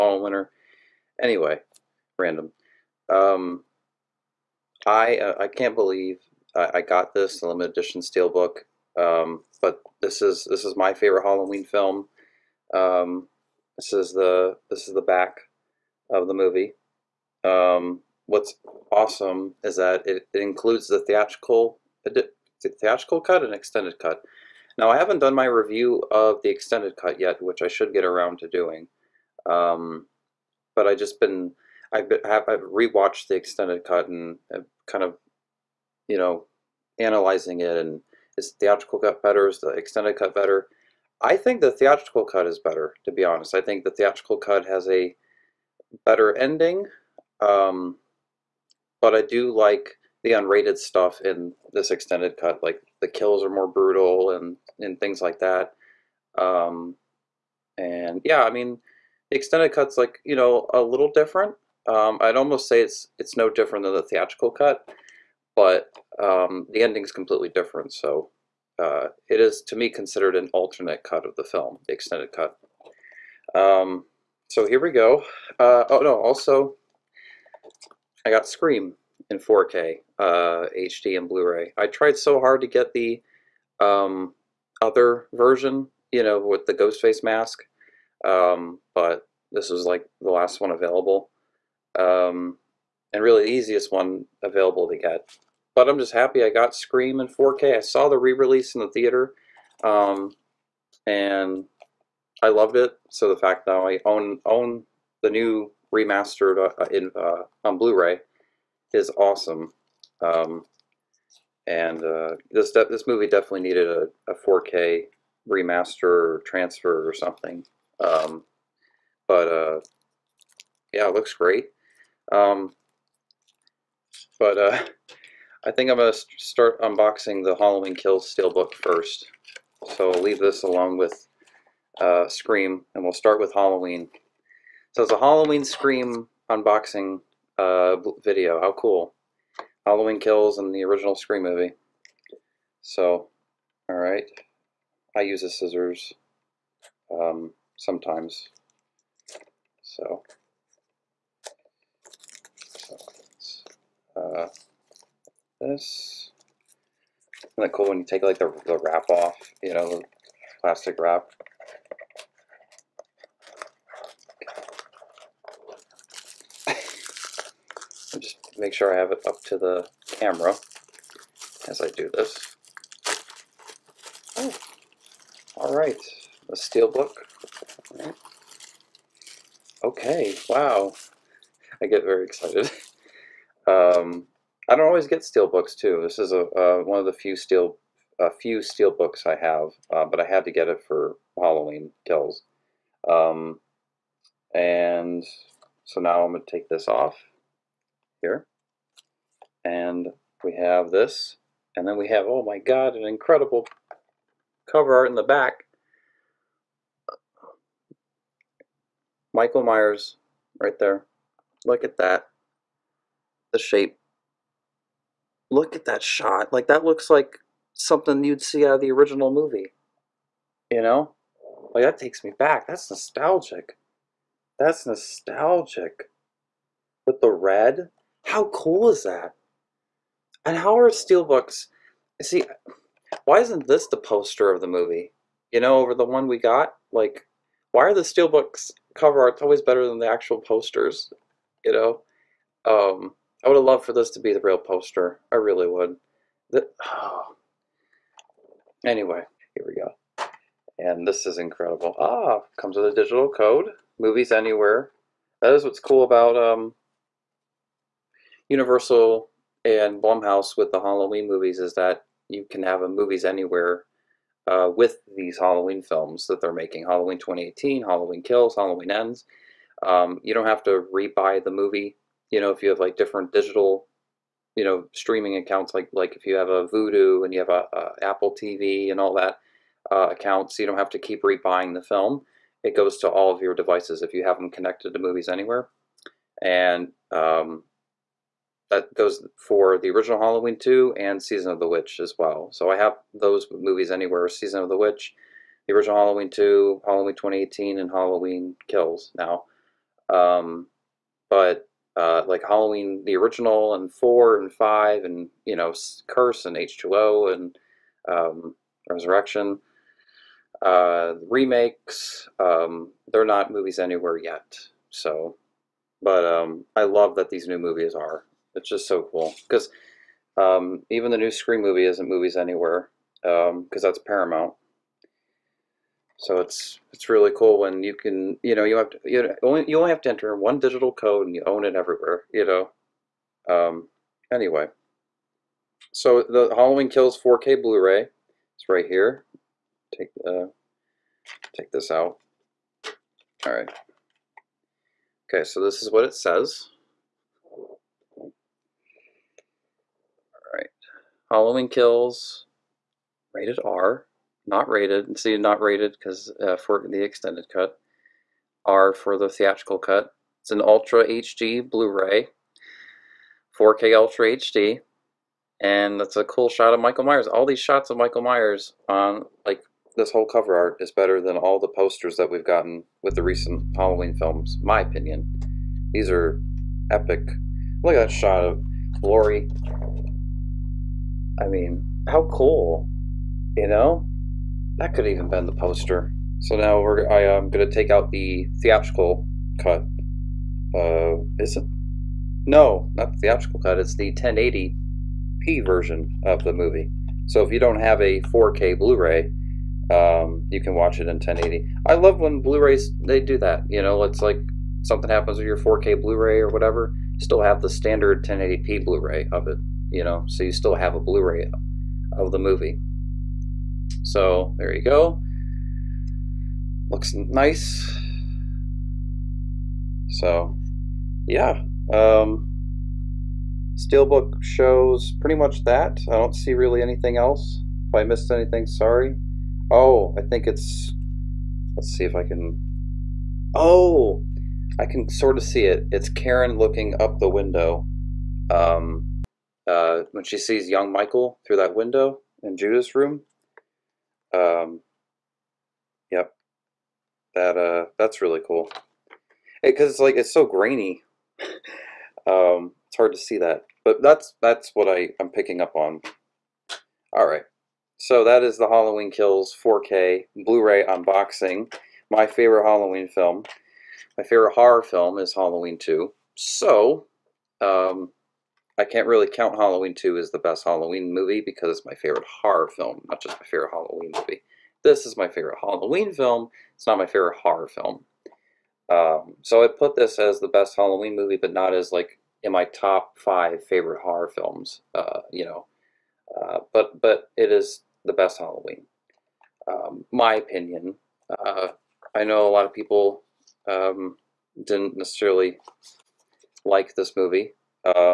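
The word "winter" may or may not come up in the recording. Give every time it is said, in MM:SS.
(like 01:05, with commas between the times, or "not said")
00:00.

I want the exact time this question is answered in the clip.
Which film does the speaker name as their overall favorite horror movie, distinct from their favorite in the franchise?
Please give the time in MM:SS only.
07:44.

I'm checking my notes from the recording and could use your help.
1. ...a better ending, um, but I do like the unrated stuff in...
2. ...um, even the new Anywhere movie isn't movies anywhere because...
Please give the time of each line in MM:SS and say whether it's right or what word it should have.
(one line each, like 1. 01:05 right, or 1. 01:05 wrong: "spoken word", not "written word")
1. 00:44 right
2. 05:20 wrong: "Scream", not "Anywhere".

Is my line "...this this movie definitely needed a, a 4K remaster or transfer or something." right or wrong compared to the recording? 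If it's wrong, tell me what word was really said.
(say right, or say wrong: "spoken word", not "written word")
right.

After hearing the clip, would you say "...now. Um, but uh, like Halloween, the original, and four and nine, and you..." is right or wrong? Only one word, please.
wrong.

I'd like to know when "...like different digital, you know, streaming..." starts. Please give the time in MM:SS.
04:32.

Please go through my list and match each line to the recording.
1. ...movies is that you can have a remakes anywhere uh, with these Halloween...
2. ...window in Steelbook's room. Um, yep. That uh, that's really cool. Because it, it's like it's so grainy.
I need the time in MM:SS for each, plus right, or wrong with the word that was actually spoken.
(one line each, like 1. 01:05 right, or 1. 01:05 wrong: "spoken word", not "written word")
1. 04:21 wrong: "movies", not "remakes"
2. 07:21 wrong: "Judith", not "Steelbook".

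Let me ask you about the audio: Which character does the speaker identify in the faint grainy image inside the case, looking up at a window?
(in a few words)
Karen.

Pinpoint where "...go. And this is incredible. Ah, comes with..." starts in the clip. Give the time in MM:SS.
04:09.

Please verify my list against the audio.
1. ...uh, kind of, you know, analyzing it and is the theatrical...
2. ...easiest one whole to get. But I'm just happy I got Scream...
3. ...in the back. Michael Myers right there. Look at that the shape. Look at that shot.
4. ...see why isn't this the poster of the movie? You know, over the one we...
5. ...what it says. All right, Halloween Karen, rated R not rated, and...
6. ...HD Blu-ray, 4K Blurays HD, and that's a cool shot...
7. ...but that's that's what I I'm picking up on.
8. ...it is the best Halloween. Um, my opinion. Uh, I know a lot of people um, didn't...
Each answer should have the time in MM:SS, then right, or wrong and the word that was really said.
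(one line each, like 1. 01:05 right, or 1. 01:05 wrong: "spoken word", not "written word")
1. 00:34 right
2. 01:33 wrong: "available", not "whole"
3. 03:25 right
4. 03:52 right
5. 05:45 wrong: "Kills", not "Karen"
6. 06:01 wrong: "Ultra", not "Blurays"
7. 07:33 right
8. 08:07 right.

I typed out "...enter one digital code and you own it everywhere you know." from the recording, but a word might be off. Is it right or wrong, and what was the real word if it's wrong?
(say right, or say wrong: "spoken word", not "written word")
right.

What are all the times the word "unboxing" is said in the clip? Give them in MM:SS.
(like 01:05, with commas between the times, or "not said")
02:06, 02:16, 07:40.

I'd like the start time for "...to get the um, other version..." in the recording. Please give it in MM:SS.
01:22.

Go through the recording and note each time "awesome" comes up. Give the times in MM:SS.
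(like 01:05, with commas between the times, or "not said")
00:18, 01:49.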